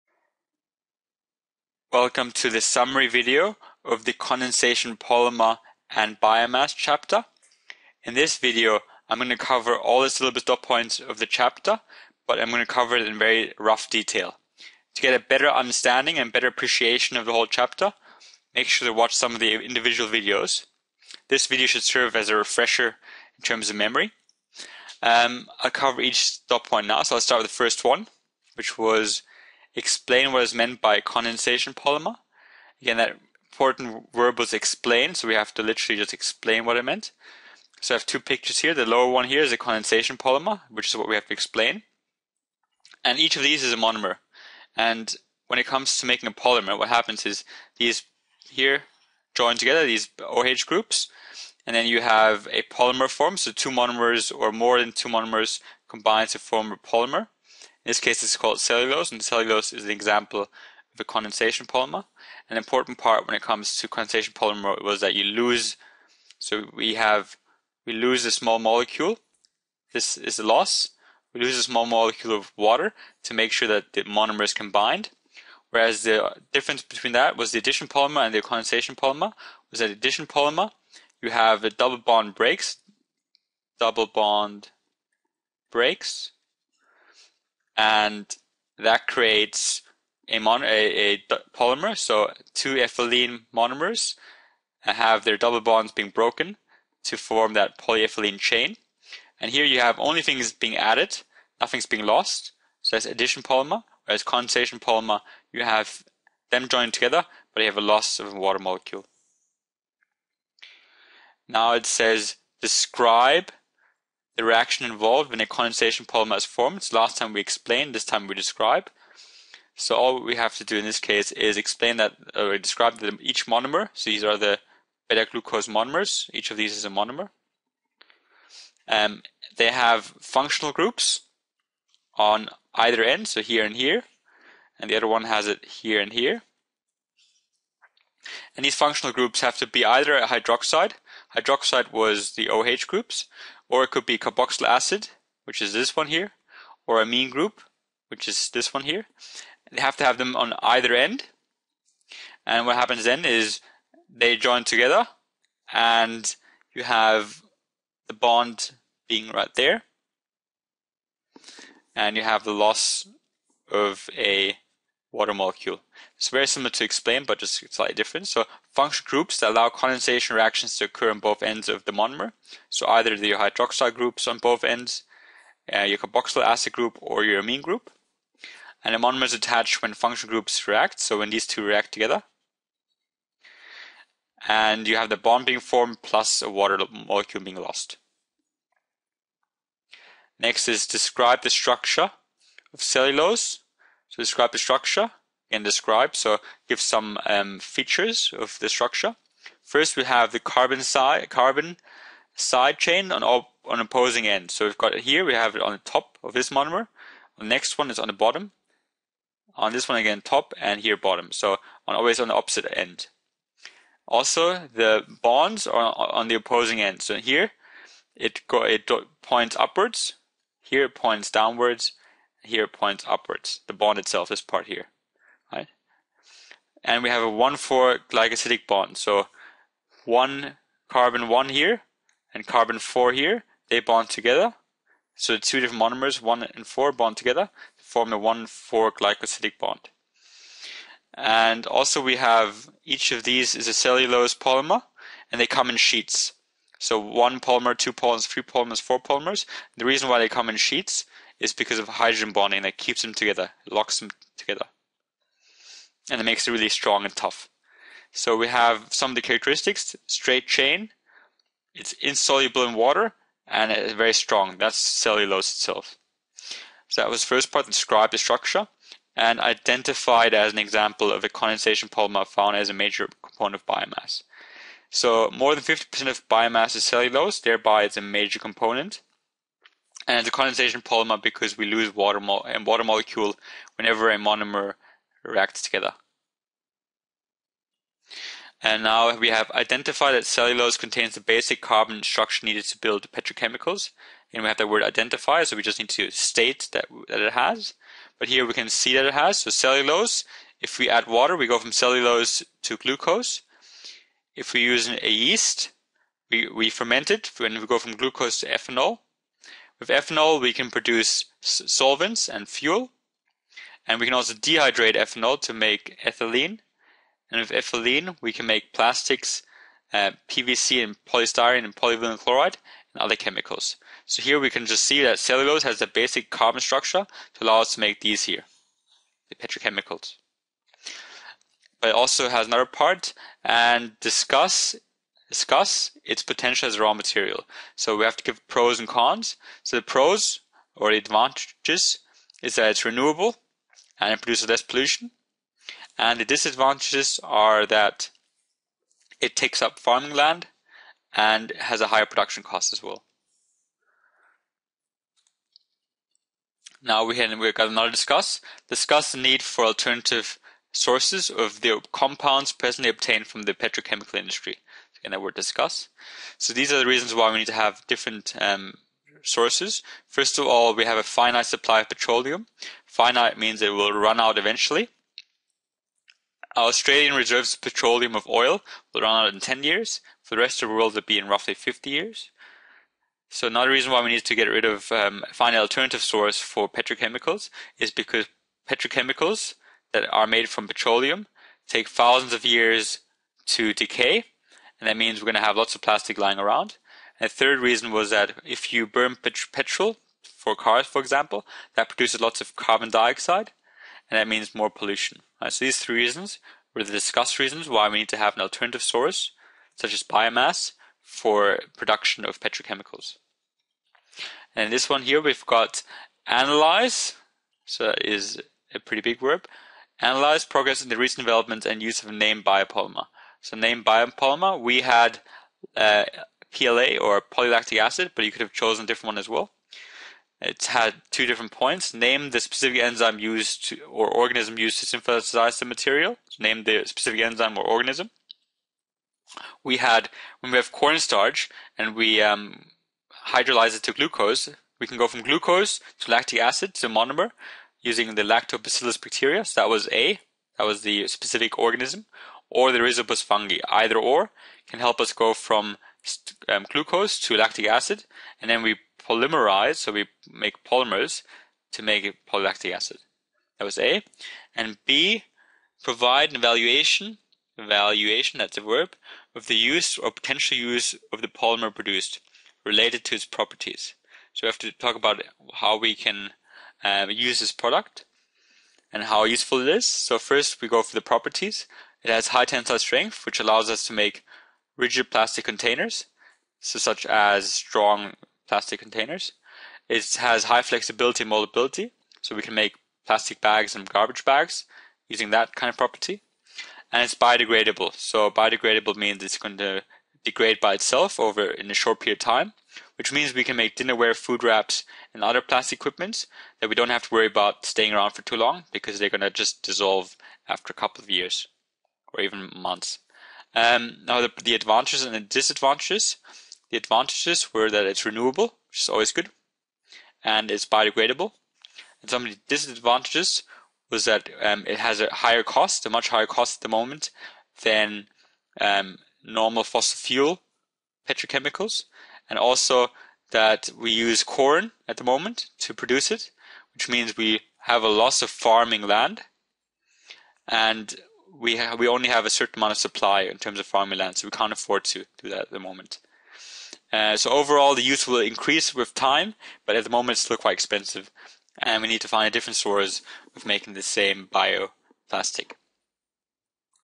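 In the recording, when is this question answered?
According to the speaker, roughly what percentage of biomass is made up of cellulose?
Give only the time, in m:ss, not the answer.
4:35.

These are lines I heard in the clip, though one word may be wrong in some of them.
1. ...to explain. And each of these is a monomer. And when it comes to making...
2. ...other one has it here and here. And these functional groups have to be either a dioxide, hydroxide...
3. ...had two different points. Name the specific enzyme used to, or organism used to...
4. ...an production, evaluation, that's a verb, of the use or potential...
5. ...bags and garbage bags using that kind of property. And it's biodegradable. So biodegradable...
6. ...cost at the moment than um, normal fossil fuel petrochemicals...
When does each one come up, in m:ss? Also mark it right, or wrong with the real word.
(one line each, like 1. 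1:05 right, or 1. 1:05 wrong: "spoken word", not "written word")
1. 0:41 right
2. 2:14 wrong: "hydroxide", not "dioxide"
3. 7:10 right
4. 7:46 wrong: "evaluation", not "production"
5. 8:13 right
6. 8:46 right.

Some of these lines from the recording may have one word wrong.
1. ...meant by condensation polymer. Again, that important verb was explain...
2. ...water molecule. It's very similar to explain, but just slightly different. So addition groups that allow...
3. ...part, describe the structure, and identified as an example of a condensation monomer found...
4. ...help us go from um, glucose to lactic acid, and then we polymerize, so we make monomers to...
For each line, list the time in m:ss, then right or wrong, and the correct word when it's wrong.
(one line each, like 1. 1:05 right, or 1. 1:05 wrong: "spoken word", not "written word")
1. 0:30 right
2. 2:45 wrong: "function", not "addition"
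3. 4:27 wrong: "polymer", not "monomer"
4. 7:34 wrong: "polymers", not "monomers".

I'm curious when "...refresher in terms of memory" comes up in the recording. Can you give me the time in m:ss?
0:22.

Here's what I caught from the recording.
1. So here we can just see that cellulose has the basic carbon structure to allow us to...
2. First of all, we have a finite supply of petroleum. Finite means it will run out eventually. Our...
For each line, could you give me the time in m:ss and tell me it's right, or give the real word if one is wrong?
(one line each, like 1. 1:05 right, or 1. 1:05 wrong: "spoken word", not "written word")
1. 5:24 right
2. 6:10 right.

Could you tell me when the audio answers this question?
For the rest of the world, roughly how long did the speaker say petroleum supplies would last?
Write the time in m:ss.
6:21.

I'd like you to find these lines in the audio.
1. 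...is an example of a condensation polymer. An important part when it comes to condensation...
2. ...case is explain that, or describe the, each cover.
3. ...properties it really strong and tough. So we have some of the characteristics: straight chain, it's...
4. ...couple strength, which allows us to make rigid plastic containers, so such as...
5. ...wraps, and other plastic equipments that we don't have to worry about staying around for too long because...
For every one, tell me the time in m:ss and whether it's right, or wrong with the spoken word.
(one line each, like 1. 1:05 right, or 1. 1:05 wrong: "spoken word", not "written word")
1. 0:59 right
2. 2:00 wrong: "monomer", not "cover"
3. 4:16 wrong: "makes", not "properties"
4. 8:02 wrong: "tensile", not "couple"
5. 8:24 right.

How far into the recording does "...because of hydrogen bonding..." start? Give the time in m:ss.
4:11.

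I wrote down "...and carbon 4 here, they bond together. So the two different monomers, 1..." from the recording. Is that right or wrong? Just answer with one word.
right.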